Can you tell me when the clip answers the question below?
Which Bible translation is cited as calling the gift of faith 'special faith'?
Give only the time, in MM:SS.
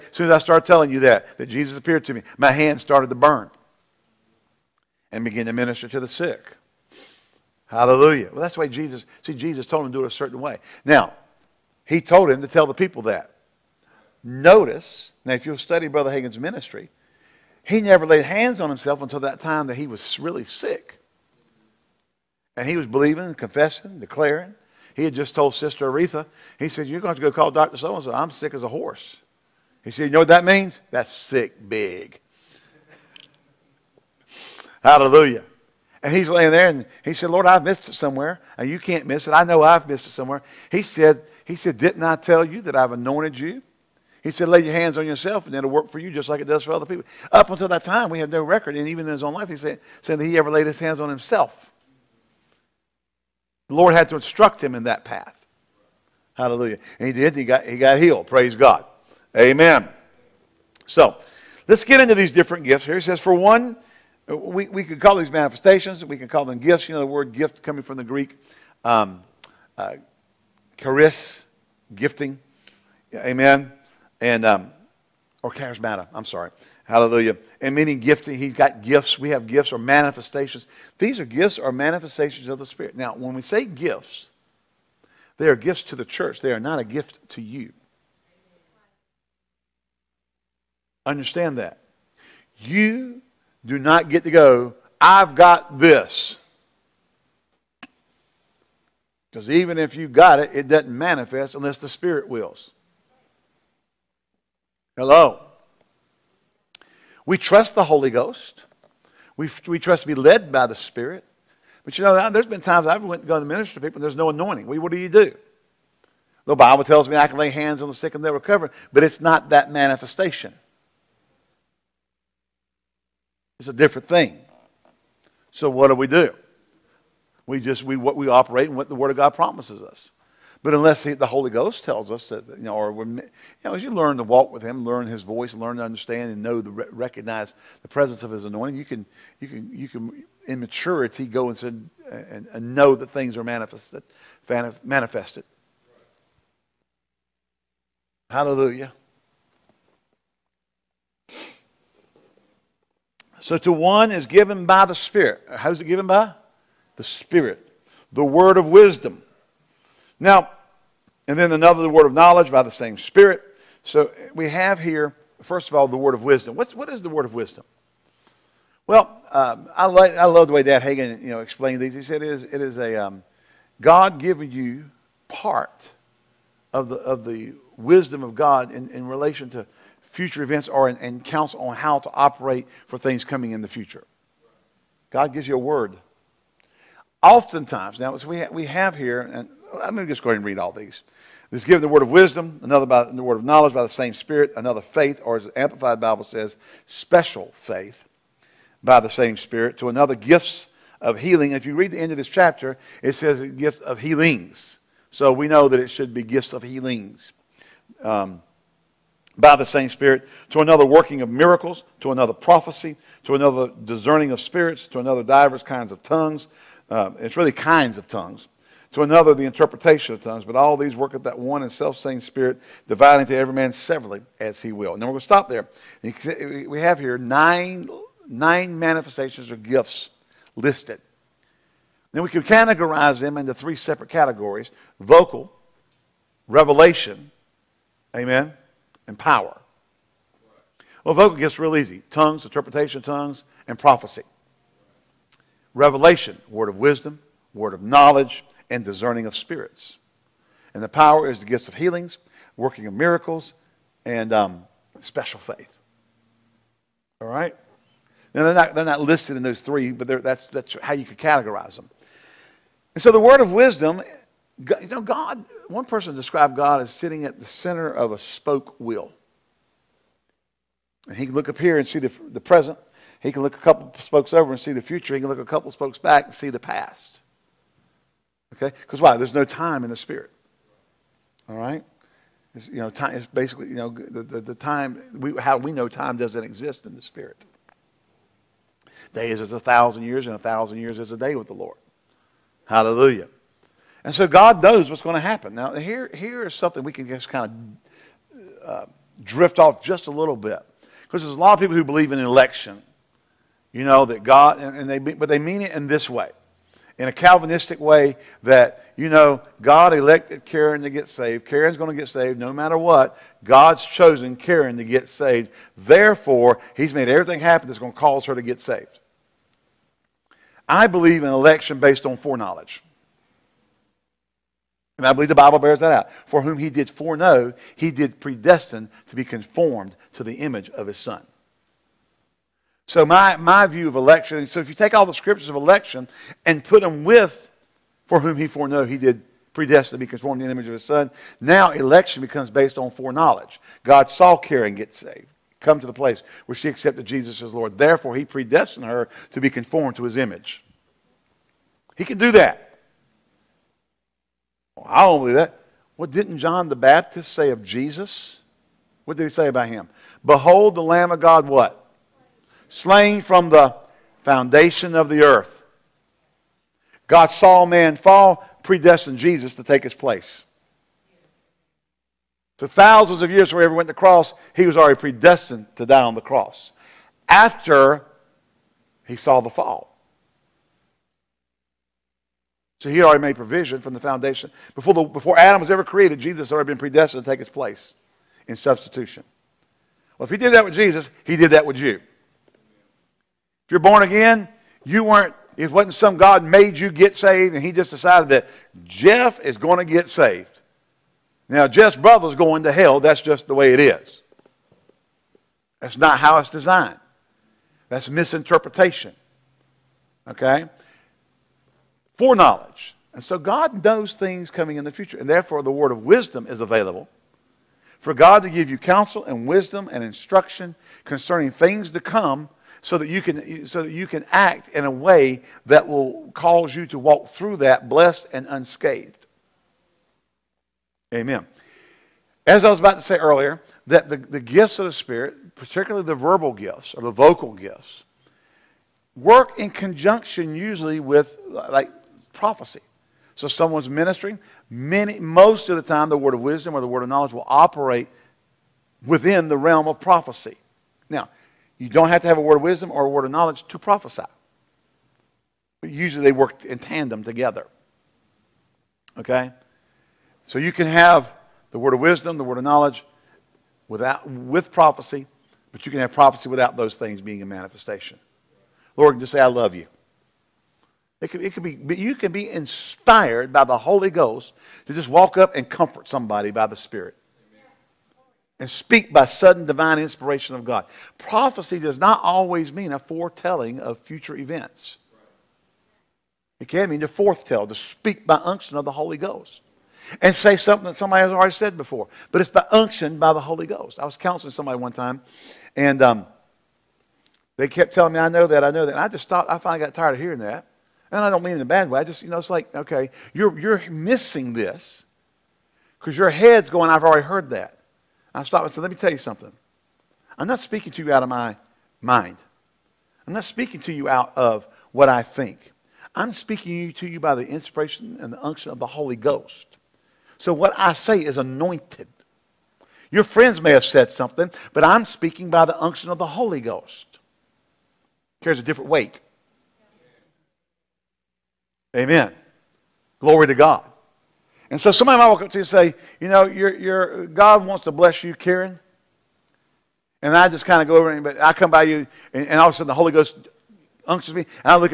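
03:15.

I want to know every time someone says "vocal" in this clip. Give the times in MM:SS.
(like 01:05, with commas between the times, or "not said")
03:54, 04:01, 07:17.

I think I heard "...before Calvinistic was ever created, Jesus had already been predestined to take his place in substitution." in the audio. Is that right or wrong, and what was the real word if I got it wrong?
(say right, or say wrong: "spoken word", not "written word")
wrong: "Adam", not "Calvinistic".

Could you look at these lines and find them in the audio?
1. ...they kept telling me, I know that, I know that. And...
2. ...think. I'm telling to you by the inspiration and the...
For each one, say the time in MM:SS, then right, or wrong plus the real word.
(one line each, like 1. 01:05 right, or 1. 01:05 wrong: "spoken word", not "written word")
1. 08:17 right
2. 08:35 wrong: "speaking", not "telling".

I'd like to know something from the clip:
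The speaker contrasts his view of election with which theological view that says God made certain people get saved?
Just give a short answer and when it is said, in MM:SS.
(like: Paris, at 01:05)
Calvinistic, at 05:07.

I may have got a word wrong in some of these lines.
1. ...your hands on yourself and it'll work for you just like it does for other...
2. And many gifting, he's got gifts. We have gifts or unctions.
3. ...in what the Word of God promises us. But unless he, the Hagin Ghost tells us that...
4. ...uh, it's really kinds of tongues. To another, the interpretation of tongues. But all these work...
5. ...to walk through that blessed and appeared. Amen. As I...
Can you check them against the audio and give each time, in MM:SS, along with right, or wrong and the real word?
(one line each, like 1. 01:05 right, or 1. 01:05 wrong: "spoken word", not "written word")
1. 00:44 right
2. 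01:17 wrong: "manifestations", not "unctions"
3. 02:08 wrong: "Holy", not "Hagin"
4. 03:36 right
5. 07:06 wrong: "unscathed", not "appeared".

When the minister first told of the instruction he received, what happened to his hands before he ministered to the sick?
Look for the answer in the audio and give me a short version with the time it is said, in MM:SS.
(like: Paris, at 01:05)
Started to burn, at 00:02.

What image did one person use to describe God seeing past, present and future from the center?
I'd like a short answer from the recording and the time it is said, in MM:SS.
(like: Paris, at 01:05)
A spoke wheel, at 04:28.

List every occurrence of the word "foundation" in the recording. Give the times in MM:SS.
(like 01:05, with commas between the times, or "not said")
06:04, 06:23.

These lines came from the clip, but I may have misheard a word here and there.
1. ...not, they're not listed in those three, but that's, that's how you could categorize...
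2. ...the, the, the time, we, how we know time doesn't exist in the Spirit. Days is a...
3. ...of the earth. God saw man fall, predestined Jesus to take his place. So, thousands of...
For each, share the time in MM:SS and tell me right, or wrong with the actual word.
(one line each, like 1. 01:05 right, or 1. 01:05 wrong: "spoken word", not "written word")
1. 04:18 right
2. 04:43 right
3. 06:04 right.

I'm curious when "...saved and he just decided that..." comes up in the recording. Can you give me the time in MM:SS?
06:37.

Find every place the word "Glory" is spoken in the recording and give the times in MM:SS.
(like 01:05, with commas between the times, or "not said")
08:53.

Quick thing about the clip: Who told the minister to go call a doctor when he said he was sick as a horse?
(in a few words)
Sister Oretha.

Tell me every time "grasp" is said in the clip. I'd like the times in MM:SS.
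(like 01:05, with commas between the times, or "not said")
not said.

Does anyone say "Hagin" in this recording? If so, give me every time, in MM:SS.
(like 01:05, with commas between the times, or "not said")
00:16, 02:50.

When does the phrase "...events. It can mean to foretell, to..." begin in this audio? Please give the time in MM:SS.
08:04.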